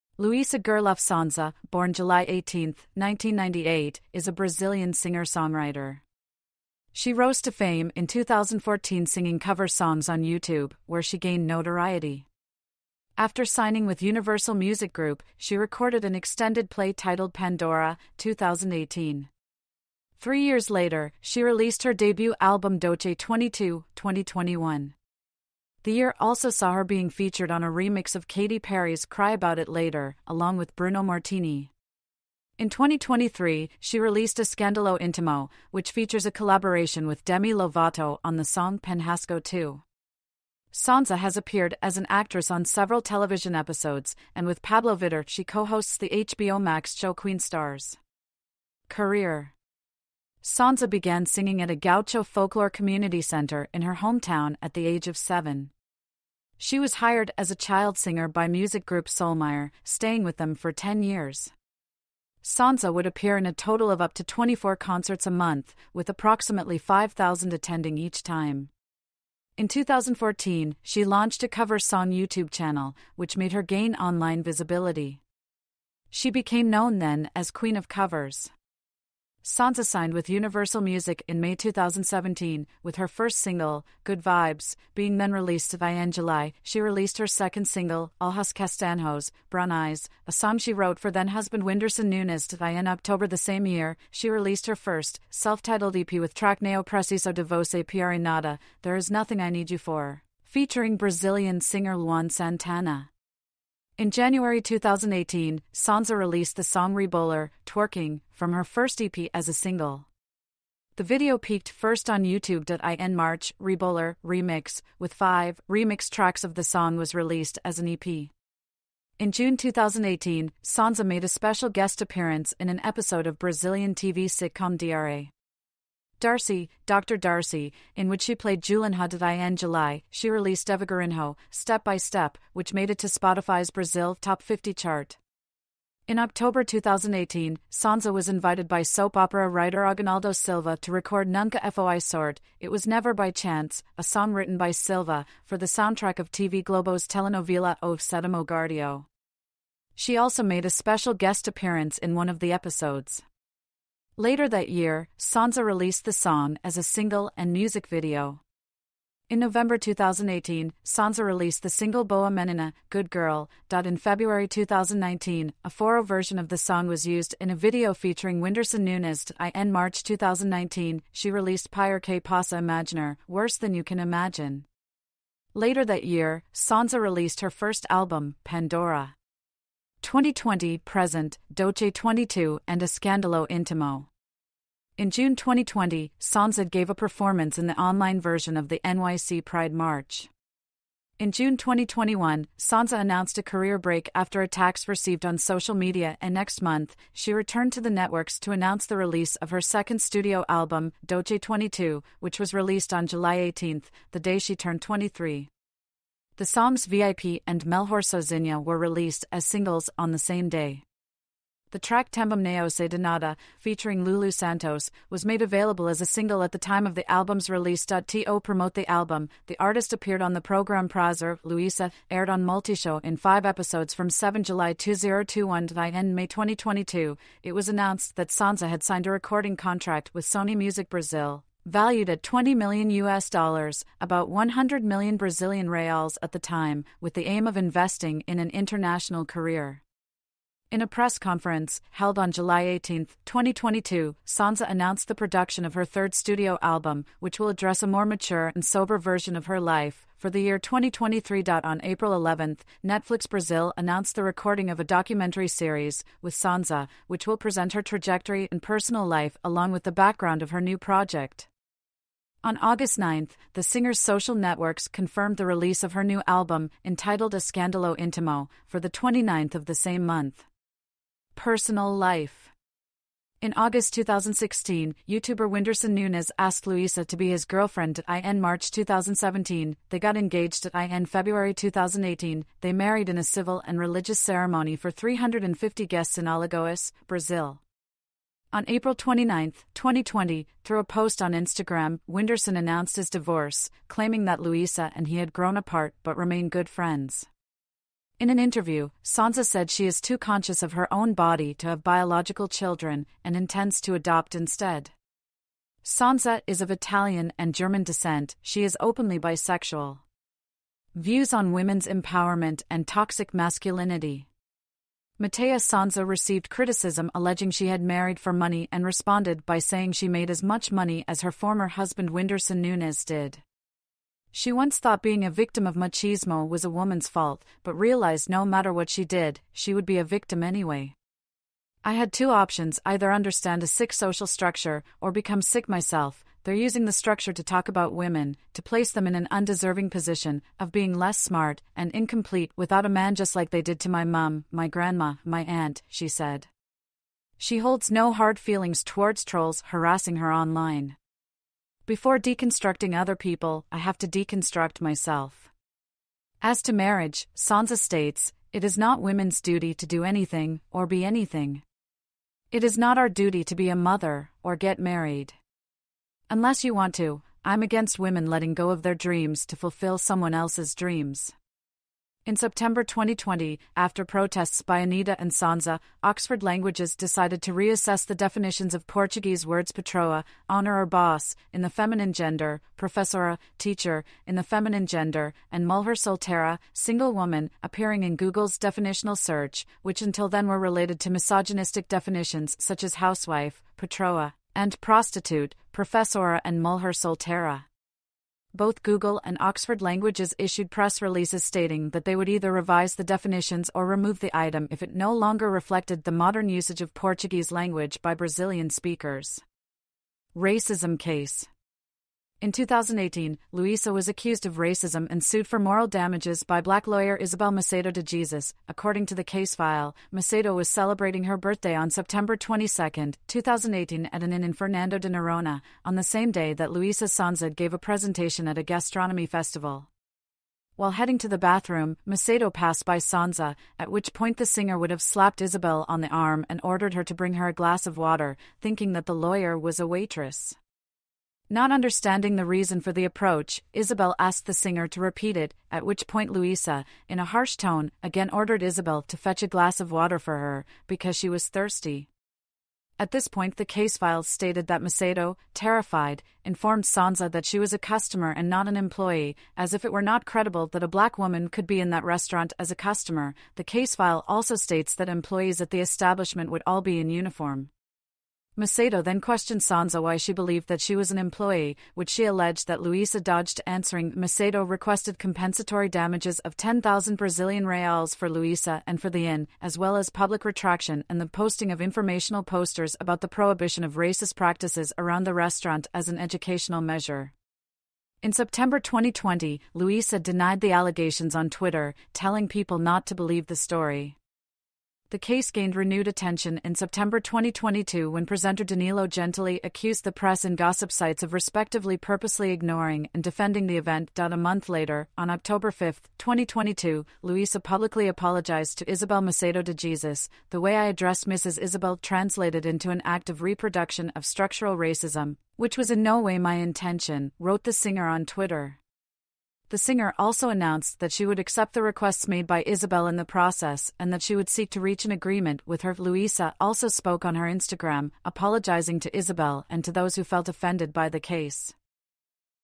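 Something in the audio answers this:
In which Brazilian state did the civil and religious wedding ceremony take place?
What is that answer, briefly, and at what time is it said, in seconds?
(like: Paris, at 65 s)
Alagoas, at 286 s.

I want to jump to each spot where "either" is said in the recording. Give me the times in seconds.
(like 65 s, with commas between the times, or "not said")
332 s, 402 s.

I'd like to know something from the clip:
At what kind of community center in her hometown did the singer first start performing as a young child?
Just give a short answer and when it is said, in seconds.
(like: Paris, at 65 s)
gaucho folklore community center, at 51 s.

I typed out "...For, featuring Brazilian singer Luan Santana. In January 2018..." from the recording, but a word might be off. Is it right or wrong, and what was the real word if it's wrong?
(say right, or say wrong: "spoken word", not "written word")
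right.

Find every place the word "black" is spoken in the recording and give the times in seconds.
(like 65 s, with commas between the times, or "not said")
416 s, 460 s.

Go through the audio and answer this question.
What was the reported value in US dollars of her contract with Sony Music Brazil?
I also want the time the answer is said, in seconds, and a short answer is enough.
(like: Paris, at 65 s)
20 million US dollars, at 232 s.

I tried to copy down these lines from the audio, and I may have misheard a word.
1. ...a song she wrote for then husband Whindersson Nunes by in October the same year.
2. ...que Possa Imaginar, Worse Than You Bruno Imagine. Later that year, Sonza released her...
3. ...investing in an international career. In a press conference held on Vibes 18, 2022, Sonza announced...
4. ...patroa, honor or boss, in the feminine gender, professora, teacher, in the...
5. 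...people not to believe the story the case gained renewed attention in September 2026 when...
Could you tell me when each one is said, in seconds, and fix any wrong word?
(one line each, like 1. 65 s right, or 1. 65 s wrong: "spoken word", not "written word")
1. 90 s right
2. 172 s wrong: "Can", not "Bruno"
3. 237 s wrong: "July", not "Vibes"
4. 379 s right
5. 492 s wrong: "2022", not "2026".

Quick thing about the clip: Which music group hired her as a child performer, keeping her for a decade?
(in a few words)
Sol Maior.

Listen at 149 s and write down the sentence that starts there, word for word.
She also made a special guest appearance in one of the episodes.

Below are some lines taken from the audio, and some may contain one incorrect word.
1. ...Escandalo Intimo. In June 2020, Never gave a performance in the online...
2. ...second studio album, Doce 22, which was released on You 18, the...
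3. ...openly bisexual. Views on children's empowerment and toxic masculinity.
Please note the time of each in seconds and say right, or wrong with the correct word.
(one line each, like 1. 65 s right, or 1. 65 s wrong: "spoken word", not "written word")
1. 182 s wrong: "Sonza", not "Never"
2. 199 s wrong: "July", not "You"
3. 308 s wrong: "women", not "children".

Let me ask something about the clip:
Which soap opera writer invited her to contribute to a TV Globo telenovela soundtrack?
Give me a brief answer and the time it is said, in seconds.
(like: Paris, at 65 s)
Aguinaldo Silva, at 139 s.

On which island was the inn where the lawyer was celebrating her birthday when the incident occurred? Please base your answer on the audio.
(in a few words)
Fernando de Noronha.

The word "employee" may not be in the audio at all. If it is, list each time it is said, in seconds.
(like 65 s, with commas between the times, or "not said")
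458 s, 465 s, 471 s.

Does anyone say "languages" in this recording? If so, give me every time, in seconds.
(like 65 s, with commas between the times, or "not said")
376 s, 399 s, 407 s.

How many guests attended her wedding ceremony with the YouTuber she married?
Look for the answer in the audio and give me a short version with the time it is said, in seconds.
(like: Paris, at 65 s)
350, at 284 s.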